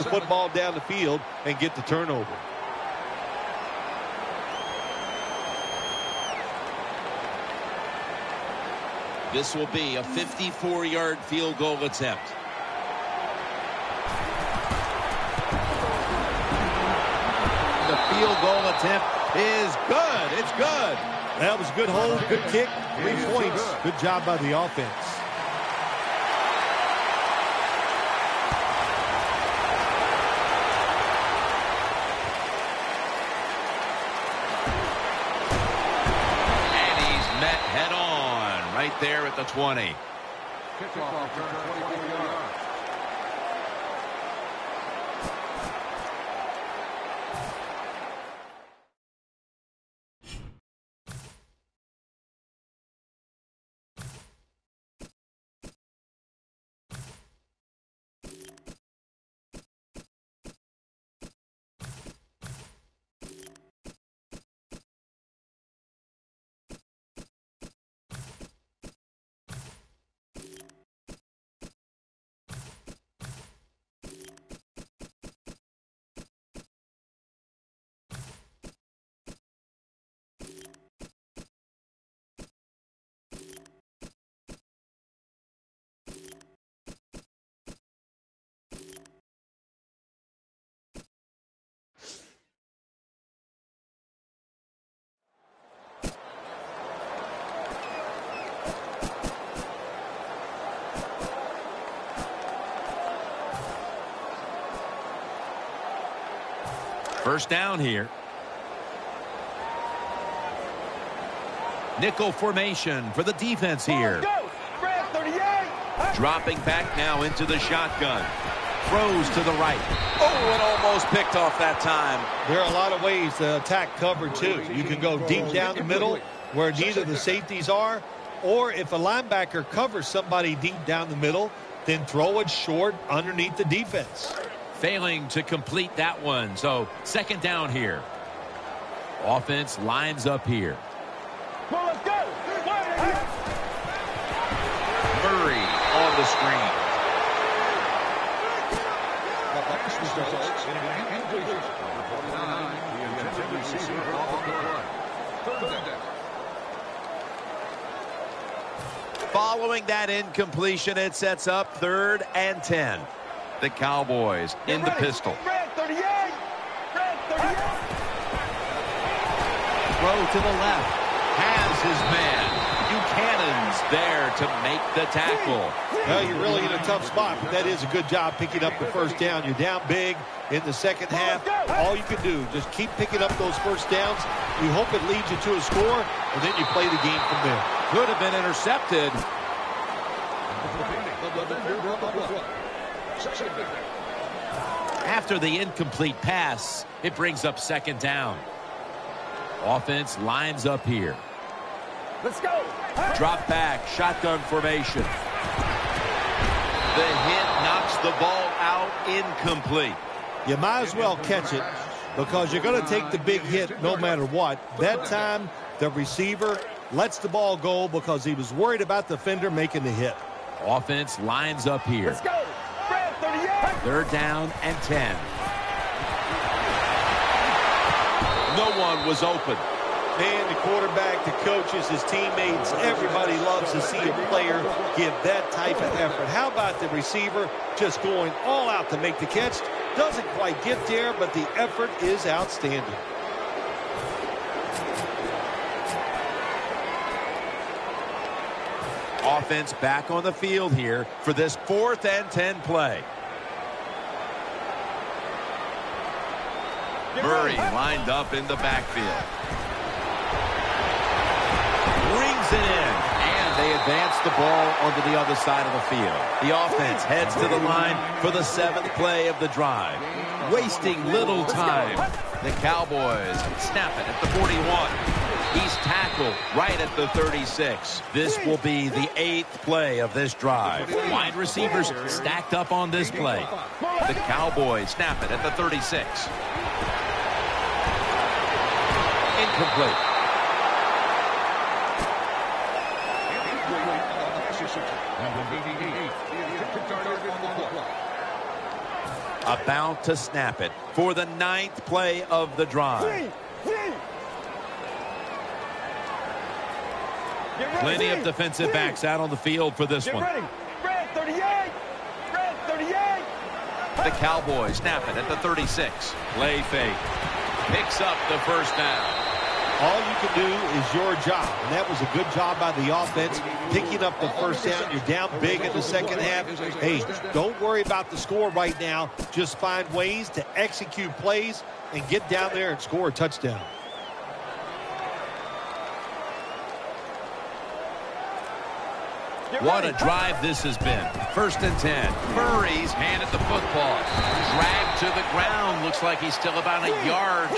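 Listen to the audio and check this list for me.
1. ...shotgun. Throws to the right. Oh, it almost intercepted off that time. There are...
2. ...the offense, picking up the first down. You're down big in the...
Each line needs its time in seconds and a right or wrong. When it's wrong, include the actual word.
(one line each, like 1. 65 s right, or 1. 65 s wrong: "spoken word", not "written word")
1. 117 s wrong: "picked", not "intercepted"
2. 322 s right.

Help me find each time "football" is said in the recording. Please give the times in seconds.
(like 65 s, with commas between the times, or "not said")
0 s, 343 s.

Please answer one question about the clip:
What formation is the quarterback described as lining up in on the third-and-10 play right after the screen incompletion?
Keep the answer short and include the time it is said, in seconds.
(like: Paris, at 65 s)
Pistol, at 164 s.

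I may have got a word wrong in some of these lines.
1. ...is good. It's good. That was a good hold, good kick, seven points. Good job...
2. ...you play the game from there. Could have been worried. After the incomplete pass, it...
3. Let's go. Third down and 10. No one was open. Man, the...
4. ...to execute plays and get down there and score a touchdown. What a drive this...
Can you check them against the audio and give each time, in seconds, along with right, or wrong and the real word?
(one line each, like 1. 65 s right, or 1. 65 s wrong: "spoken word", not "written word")
1. 19 s wrong: "three", not "seven"
2. 186 s wrong: "intercepted", not "worried"
3. 222 s right
4. 330 s right.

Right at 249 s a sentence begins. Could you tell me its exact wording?
Offense back on the field here for this fourth and 10 play.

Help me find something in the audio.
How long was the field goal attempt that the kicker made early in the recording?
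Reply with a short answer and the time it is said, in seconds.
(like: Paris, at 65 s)
54 yards, at 10 s.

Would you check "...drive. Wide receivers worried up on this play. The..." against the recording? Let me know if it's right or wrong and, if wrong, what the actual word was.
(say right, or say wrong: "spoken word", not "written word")
wrong: "stacked", not "worried".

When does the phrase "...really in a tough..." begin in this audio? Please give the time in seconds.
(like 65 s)
176 s.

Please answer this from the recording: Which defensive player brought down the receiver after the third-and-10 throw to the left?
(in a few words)
Buchanan.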